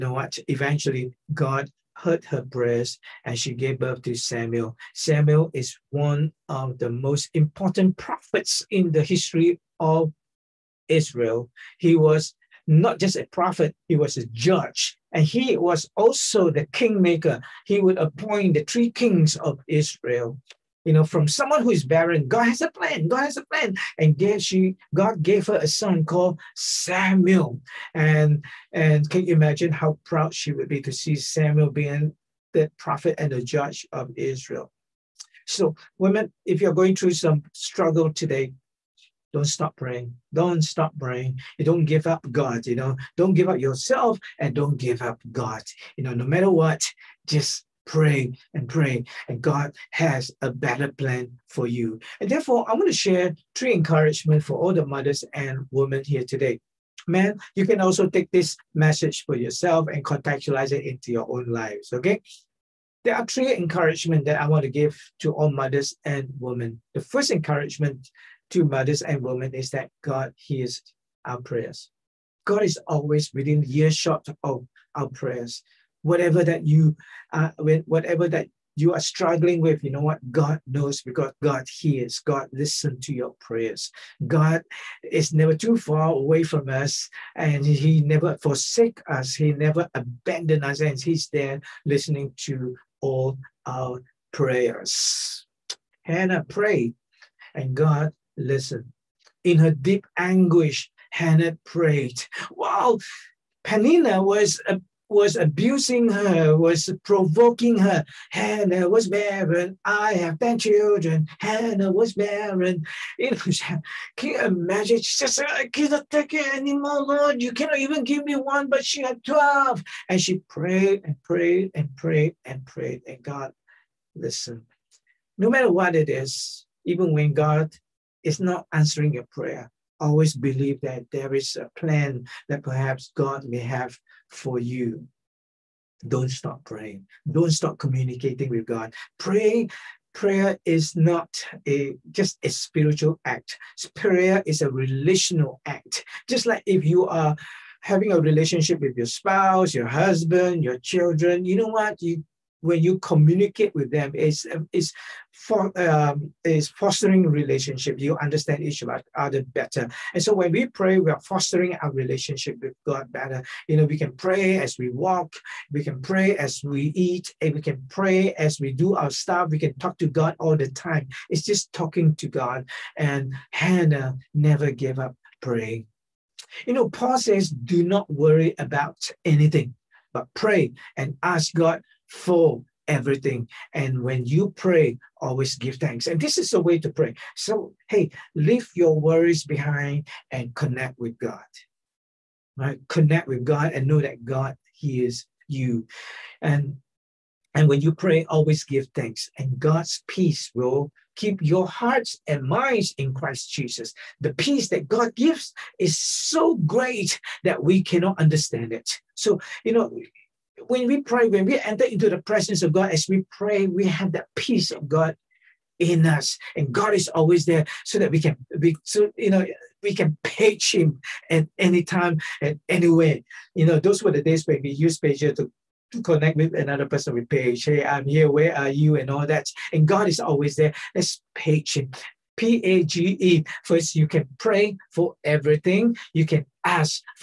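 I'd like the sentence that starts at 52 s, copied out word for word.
And therefore, I want to share three encouragement for all the mothers and women here today.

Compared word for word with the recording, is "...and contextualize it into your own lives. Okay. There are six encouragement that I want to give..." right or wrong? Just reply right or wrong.
wrong.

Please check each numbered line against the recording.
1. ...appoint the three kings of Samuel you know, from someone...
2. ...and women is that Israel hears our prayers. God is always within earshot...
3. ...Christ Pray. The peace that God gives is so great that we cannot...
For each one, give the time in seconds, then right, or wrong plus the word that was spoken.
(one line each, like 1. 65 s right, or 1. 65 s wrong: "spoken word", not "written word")
1. 17 s wrong: "Israel", not "Samuel"
2. 69 s wrong: "God", not "Israel"
3. 203 s wrong: "Jesus", not "Pray".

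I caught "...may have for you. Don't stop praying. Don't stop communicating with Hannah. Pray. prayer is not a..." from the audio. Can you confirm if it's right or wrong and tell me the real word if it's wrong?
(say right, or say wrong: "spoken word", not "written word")
wrong: "God", not "Hannah".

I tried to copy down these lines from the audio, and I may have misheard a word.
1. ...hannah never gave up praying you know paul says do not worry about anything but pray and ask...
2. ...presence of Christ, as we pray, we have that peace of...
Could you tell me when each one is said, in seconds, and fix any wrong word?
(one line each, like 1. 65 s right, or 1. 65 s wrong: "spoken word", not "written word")
1. 173 s right
2. 212 s wrong: "God", not "Christ".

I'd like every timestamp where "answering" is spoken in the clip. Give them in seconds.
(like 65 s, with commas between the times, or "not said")
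128 s.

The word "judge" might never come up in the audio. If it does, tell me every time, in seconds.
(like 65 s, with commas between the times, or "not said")
14 s, 33 s.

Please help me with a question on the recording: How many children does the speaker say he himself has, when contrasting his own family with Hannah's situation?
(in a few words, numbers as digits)
10.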